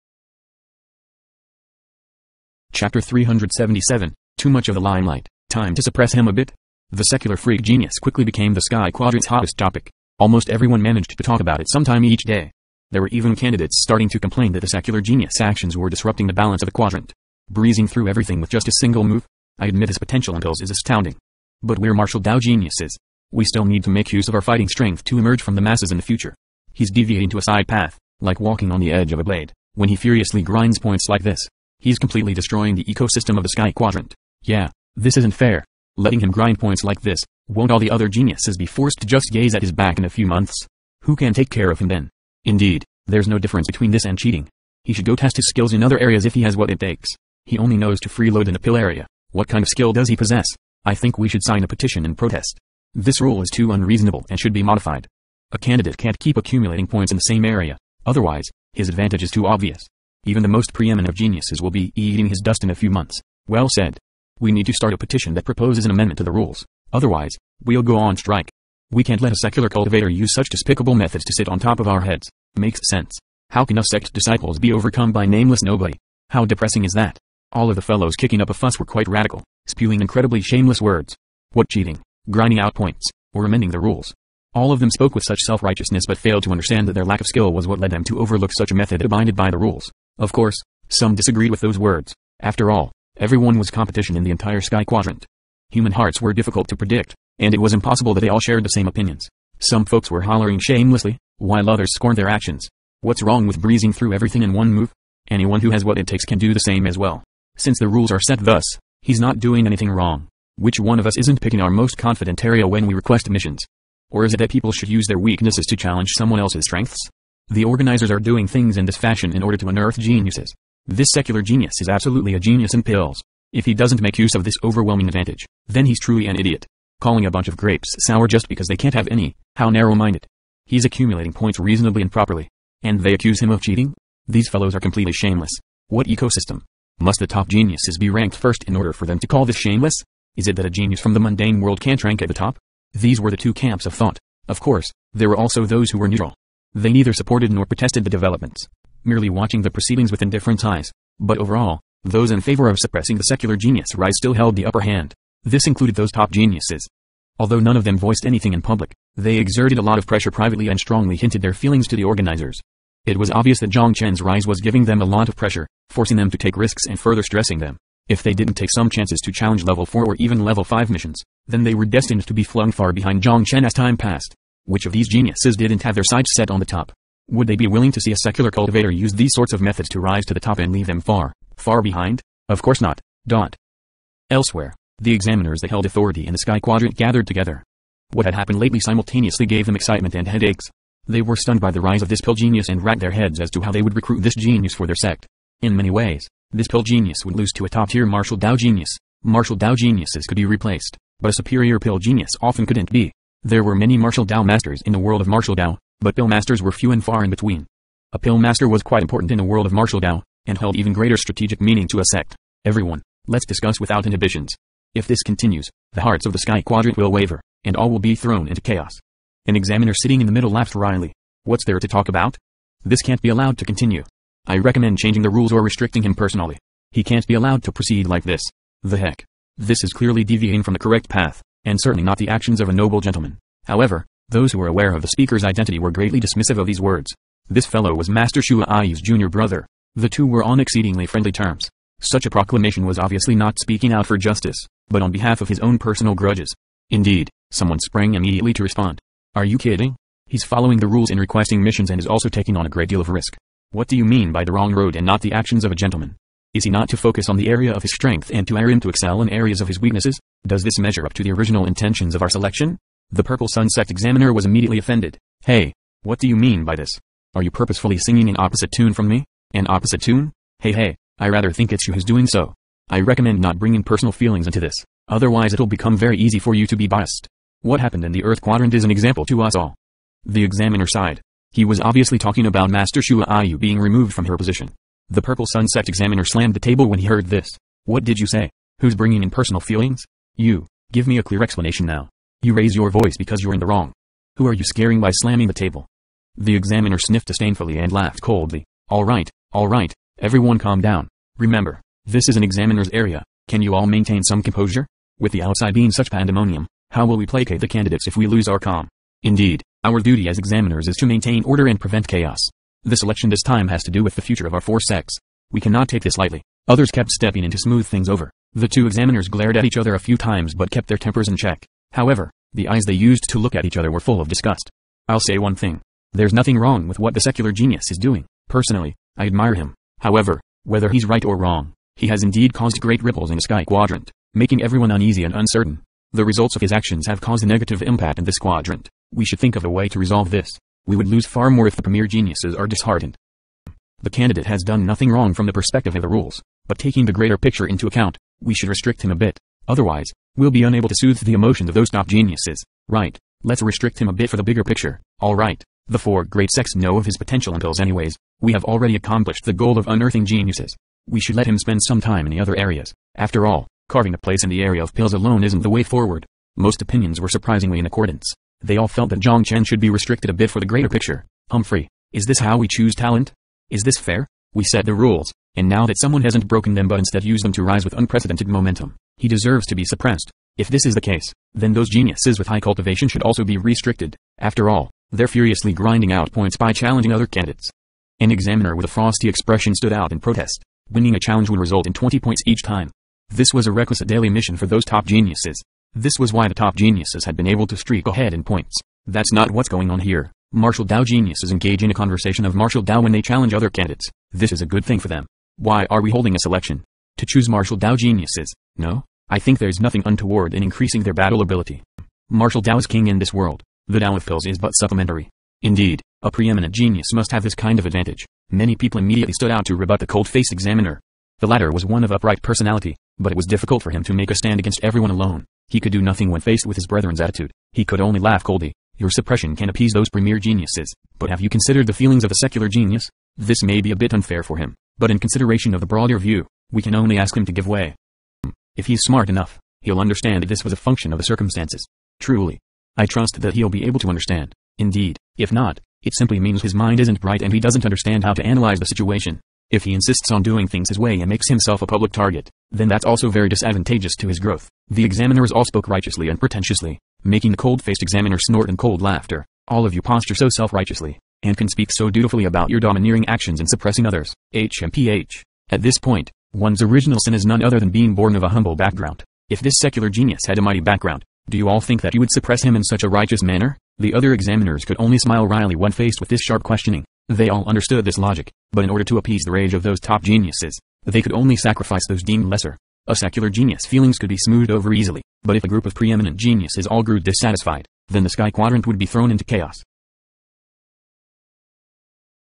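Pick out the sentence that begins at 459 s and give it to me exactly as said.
All of you posture so self-righteously, and can speak so dutifully about your domineering actions and suppressing others.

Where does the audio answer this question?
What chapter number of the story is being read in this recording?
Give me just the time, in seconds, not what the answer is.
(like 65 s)
2 s.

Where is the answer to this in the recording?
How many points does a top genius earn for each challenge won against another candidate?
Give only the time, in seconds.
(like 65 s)
391 s.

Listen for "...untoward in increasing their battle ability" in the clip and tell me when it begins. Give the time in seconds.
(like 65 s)
410 s.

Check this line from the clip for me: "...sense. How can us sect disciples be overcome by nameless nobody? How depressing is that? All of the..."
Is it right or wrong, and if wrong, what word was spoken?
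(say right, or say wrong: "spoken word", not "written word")
right.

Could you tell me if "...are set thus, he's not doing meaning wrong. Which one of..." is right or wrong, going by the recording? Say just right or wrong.
wrong.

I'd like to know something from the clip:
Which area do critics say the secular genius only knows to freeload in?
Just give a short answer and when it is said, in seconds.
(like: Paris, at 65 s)
a pill area, at 48 s.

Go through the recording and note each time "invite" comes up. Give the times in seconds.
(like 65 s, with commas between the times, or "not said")
not said.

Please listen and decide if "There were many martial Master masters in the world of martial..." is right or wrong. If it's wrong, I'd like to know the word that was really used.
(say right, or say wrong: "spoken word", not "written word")
wrong: "Dao", not "Master".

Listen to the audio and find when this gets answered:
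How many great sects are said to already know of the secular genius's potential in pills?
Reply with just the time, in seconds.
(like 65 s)
355 s.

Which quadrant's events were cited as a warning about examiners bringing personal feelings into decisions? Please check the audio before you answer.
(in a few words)
Earth Quadrant.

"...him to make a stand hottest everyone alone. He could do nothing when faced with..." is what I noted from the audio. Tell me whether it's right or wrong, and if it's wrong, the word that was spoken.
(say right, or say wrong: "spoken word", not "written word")
wrong: "against", not "hottest".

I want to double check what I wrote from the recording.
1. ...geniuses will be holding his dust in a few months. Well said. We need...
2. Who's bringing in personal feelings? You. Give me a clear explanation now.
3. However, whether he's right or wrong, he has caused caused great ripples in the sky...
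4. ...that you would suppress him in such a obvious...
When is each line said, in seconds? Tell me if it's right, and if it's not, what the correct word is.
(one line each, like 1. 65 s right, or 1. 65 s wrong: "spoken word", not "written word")
1. 61 s wrong: "eating", not "holding"
2. 288 s right
3. 329 s wrong: "indeed", not "caused"
4. 472 s wrong: "righteous", not "obvious".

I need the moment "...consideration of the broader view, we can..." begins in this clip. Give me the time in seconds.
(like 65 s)
435 s.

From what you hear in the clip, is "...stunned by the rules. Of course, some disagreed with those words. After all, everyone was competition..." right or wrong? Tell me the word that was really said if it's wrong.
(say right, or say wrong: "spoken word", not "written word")
wrong: "abided", not "stunned".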